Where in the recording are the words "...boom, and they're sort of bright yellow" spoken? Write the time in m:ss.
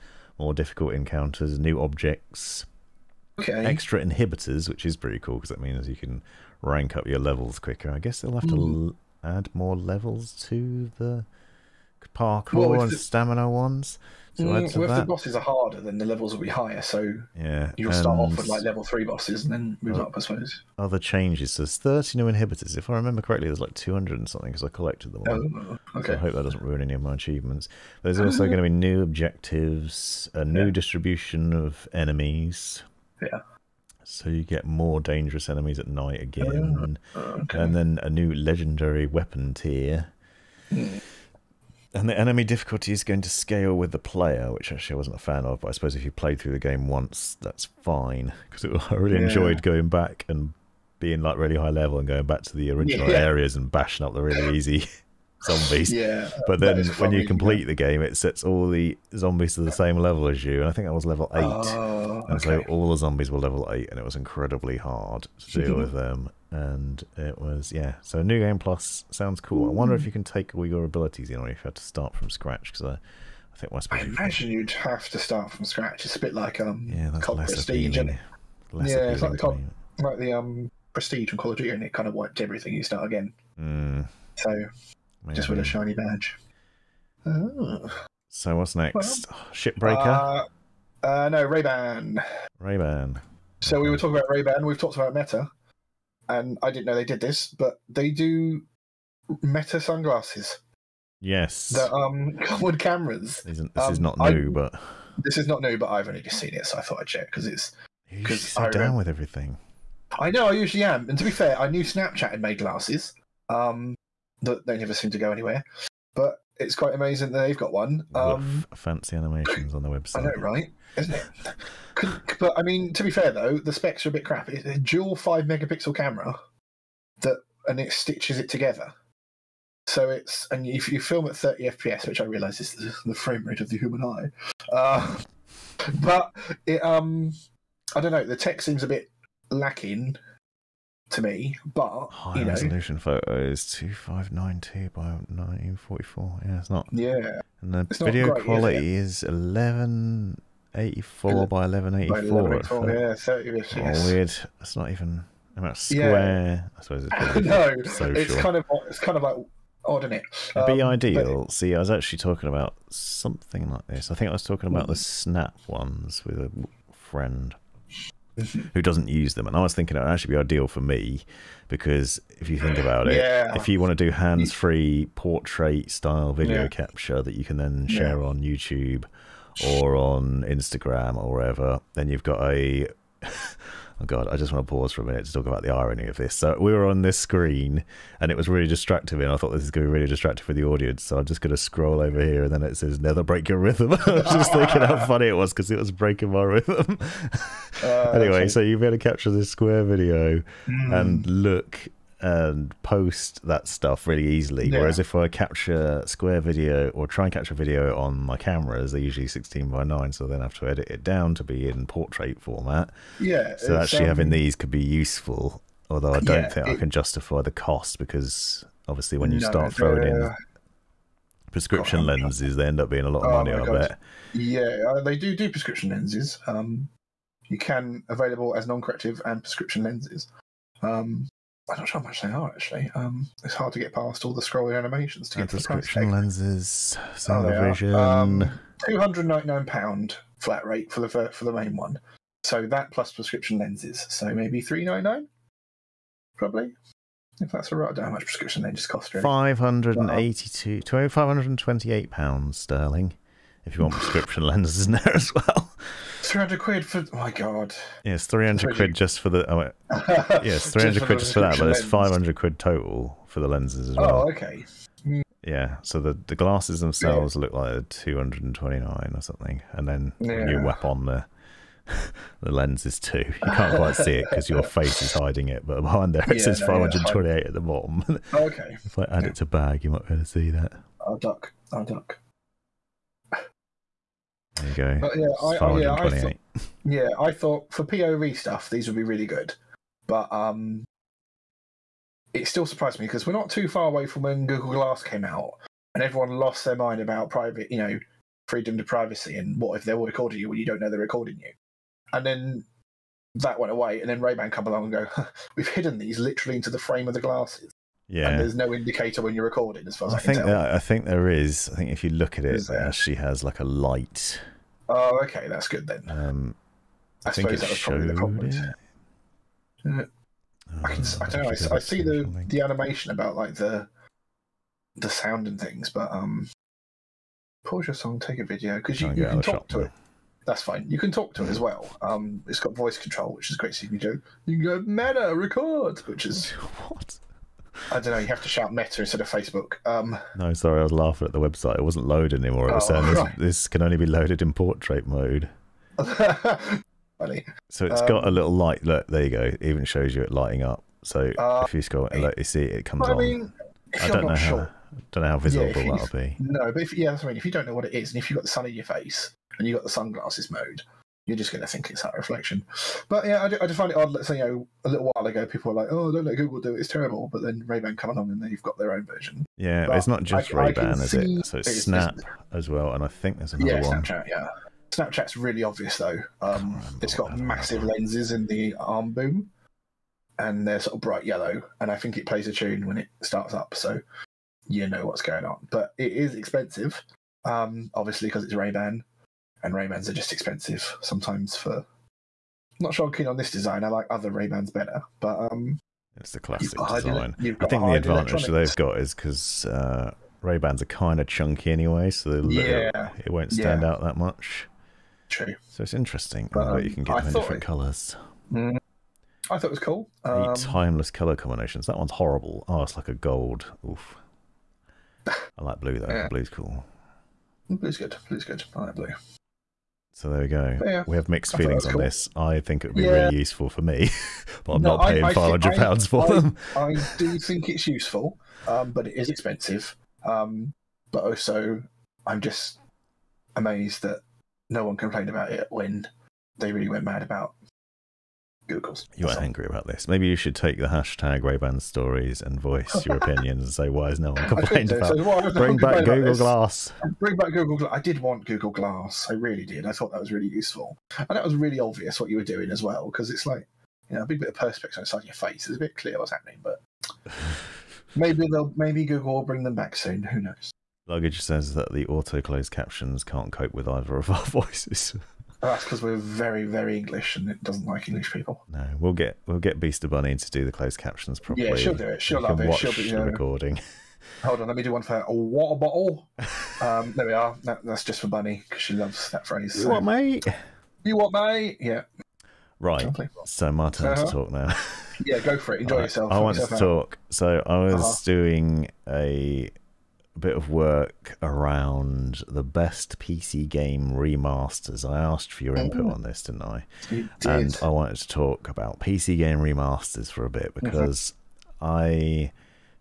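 6:19.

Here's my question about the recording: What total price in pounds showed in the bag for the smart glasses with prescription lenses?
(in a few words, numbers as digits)
£528.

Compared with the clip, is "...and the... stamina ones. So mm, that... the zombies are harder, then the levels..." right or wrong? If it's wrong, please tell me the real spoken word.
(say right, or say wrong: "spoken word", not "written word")
wrong: "bosses", not "zombies".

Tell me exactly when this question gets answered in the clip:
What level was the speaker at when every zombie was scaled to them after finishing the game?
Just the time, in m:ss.
1:00.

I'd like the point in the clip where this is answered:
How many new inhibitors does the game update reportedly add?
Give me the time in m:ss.
0:21.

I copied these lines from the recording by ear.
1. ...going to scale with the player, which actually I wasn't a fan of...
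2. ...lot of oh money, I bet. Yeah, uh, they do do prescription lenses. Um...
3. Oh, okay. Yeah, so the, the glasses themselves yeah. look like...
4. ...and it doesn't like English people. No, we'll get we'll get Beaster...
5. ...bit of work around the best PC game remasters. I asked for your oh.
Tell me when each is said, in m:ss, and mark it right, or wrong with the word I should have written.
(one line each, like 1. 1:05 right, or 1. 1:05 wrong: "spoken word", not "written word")
1. 0:43 right
2. 3:43 right
3. 4:24 right
4. 7:47 right
5. 8:10 right.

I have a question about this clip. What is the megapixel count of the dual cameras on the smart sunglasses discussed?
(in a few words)
5 megapixels.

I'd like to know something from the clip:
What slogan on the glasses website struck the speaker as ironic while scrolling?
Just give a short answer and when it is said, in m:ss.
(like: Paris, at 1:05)
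Never break your rhythm, at 3:12.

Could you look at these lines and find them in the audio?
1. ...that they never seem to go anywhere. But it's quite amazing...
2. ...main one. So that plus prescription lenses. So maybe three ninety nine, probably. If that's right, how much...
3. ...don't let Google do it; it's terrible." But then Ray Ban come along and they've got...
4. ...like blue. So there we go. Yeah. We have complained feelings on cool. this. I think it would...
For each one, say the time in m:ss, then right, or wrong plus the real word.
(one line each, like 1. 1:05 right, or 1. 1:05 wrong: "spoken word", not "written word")
1. 1:54 right
2. 4:01 right
3. 6:06 right
4. 6:58 wrong: "mixed", not "complained".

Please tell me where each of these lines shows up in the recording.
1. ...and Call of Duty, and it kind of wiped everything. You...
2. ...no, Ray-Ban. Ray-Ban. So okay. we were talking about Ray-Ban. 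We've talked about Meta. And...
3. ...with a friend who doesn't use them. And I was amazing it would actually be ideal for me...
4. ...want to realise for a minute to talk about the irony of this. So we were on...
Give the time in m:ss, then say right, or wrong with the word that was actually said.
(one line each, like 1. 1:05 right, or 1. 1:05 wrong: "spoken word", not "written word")
1. 1:21 right
2. 1:31 right
3. 2:46 wrong: "thinking", not "amazing"
4. 3:04 wrong: "pause", not "realise".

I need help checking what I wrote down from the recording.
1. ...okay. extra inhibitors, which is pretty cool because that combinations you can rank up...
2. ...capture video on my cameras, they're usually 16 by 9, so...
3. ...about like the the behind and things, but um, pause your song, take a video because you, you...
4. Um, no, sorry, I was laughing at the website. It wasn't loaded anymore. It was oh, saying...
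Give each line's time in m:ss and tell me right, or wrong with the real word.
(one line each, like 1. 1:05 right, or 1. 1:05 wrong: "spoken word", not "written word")
1. 0:03 wrong: "means", not "combinations"
2. 3:27 right
3. 5:23 wrong: "sound", not "behind"
4. 5:39 right.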